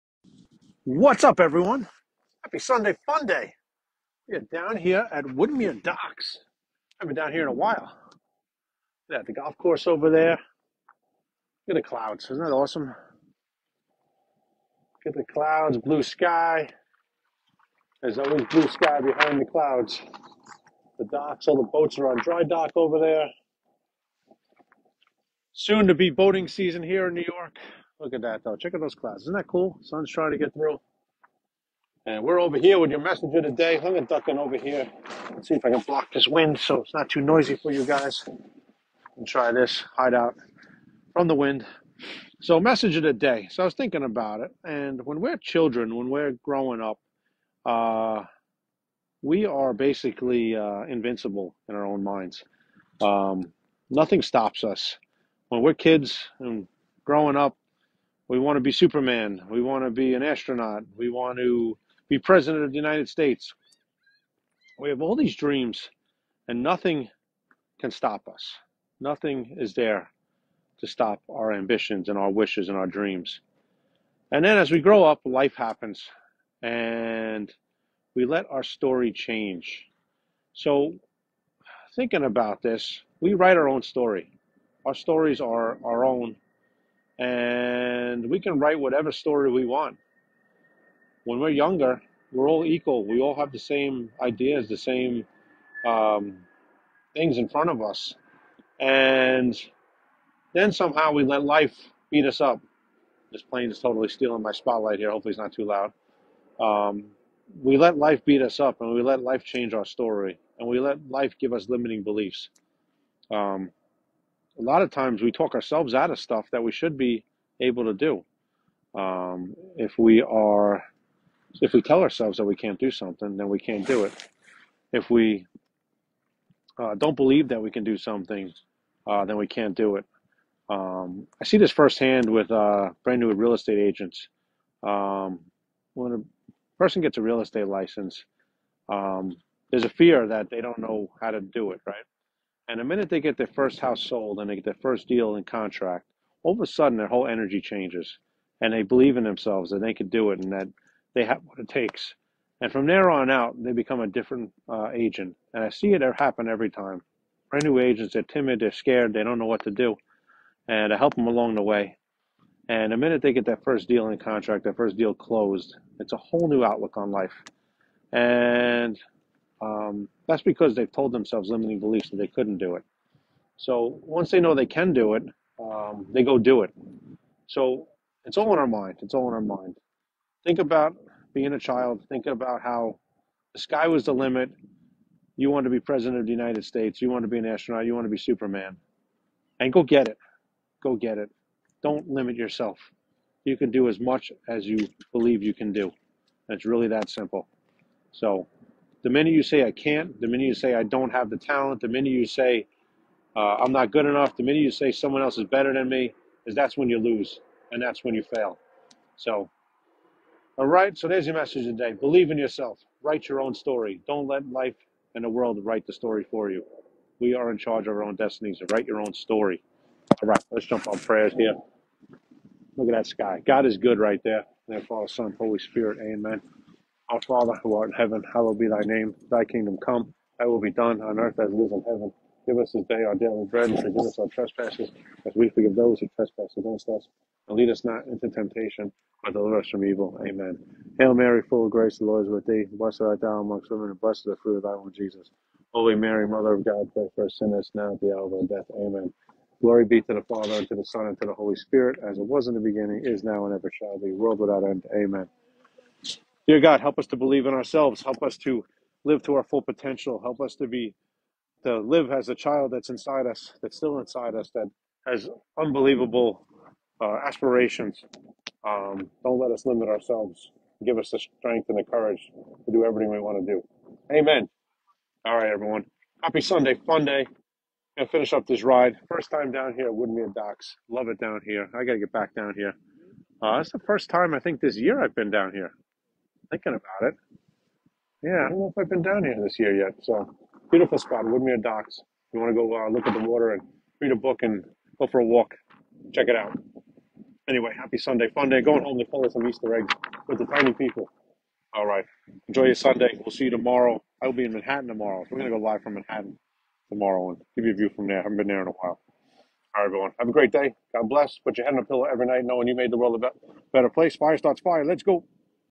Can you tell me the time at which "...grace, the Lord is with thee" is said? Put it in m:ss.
4:01.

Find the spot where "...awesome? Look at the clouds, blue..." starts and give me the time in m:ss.
0:12.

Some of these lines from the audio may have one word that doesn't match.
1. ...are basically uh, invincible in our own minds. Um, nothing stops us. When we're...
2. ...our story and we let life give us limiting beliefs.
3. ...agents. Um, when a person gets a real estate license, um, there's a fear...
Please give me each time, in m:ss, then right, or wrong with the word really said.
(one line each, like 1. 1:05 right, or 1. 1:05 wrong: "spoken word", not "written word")
1. 0:49 right
2. 1:49 right
3. 2:13 right.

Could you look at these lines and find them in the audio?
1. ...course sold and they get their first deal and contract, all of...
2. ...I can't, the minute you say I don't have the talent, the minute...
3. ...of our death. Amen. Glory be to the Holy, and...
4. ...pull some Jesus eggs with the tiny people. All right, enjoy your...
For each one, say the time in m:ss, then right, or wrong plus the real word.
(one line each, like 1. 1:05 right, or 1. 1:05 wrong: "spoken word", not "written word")
1. 2:23 wrong: "house", not "course"
2. 3:19 right
3. 4:08 wrong: "Father", not "Holy"
4. 4:59 wrong: "Easter", not "Jesus".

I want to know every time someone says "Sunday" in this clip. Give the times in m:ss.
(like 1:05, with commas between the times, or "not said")
0:02, 4:36, 4:57, 5:02.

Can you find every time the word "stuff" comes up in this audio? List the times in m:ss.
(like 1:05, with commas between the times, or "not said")
1:56.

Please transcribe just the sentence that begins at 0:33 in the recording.
I'm gonna duck in over here.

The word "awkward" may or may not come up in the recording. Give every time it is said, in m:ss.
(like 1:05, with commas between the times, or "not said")
not said.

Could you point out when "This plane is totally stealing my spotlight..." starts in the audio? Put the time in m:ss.
1:43.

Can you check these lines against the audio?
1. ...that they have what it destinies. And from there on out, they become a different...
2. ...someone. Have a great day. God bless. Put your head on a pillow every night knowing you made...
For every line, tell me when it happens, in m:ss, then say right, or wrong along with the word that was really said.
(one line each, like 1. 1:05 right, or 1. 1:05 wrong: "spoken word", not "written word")
1. 2:30 wrong: "takes", not "destinies"
2. 5:09 wrong: "everyone", not "someone".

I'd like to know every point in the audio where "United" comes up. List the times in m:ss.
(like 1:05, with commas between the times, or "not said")
1:02, 3:06.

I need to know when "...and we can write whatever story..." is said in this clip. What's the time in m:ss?
1:27.